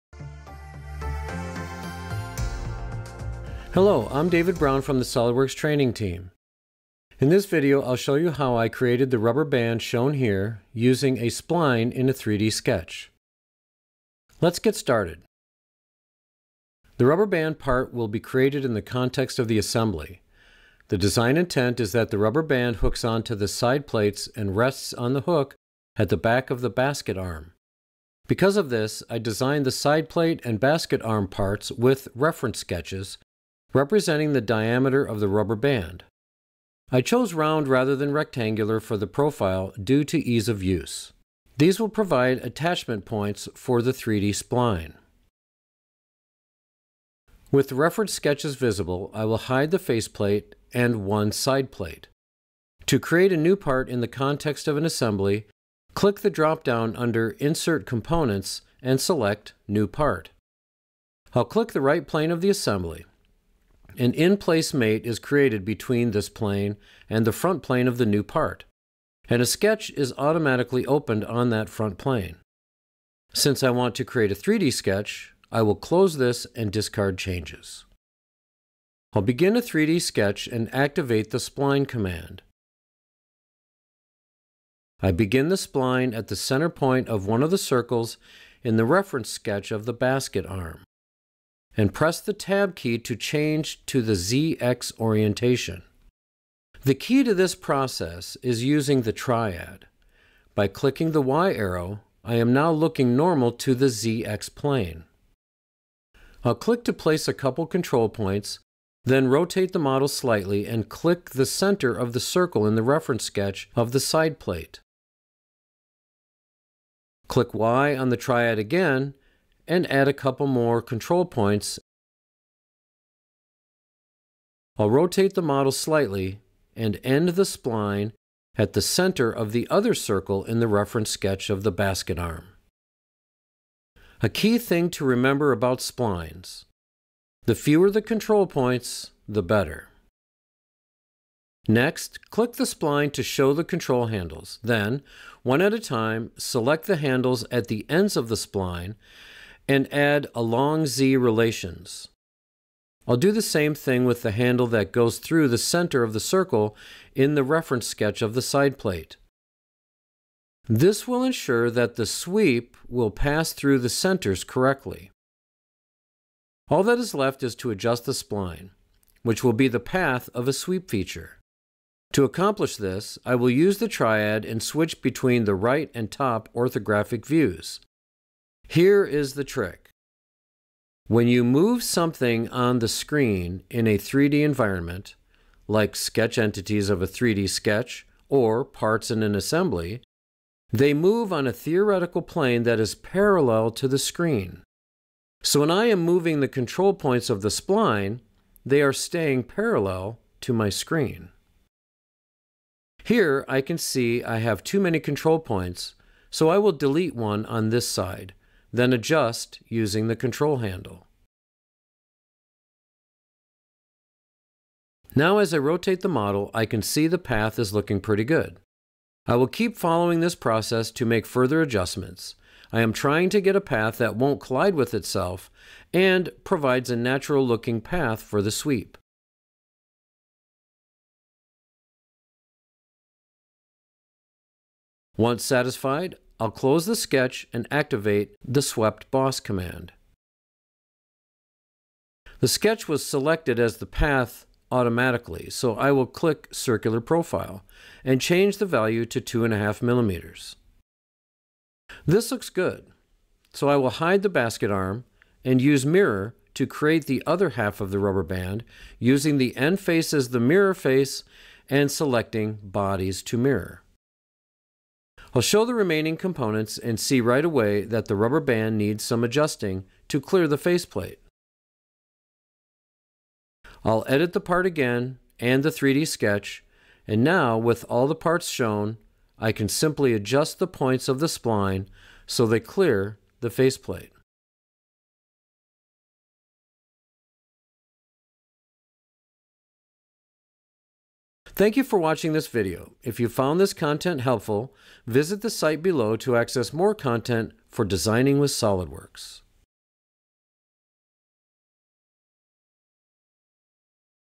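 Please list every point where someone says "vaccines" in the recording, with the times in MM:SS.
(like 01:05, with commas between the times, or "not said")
not said.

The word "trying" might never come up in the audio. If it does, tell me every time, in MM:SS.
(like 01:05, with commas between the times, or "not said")
03:42.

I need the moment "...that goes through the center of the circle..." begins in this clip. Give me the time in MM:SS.
02:34.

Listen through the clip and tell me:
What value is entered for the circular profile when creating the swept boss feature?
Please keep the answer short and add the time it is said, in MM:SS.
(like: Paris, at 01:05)
2.5 millimeters, at 04:09.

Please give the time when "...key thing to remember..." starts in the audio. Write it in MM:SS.
02:14.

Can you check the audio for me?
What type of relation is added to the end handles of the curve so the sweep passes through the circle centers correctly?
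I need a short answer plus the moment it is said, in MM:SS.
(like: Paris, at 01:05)
Along Z, at 02:30.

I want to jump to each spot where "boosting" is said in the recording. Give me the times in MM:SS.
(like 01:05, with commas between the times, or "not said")
not said.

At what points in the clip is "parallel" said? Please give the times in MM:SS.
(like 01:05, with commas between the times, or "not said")
03:12, 03:19.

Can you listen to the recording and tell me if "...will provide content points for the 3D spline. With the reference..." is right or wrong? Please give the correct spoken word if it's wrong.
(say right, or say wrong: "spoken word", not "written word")
wrong: "attachment", not "content".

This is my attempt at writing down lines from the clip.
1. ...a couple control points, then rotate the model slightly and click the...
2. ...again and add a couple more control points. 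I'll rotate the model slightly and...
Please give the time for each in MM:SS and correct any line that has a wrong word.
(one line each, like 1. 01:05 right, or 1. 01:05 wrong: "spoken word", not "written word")
1. 01:47 right
2. 01:58 right.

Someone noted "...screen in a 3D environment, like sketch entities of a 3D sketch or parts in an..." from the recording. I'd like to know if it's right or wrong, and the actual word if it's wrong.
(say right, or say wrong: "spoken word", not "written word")
right.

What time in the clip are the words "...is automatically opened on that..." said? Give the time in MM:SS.
01:09.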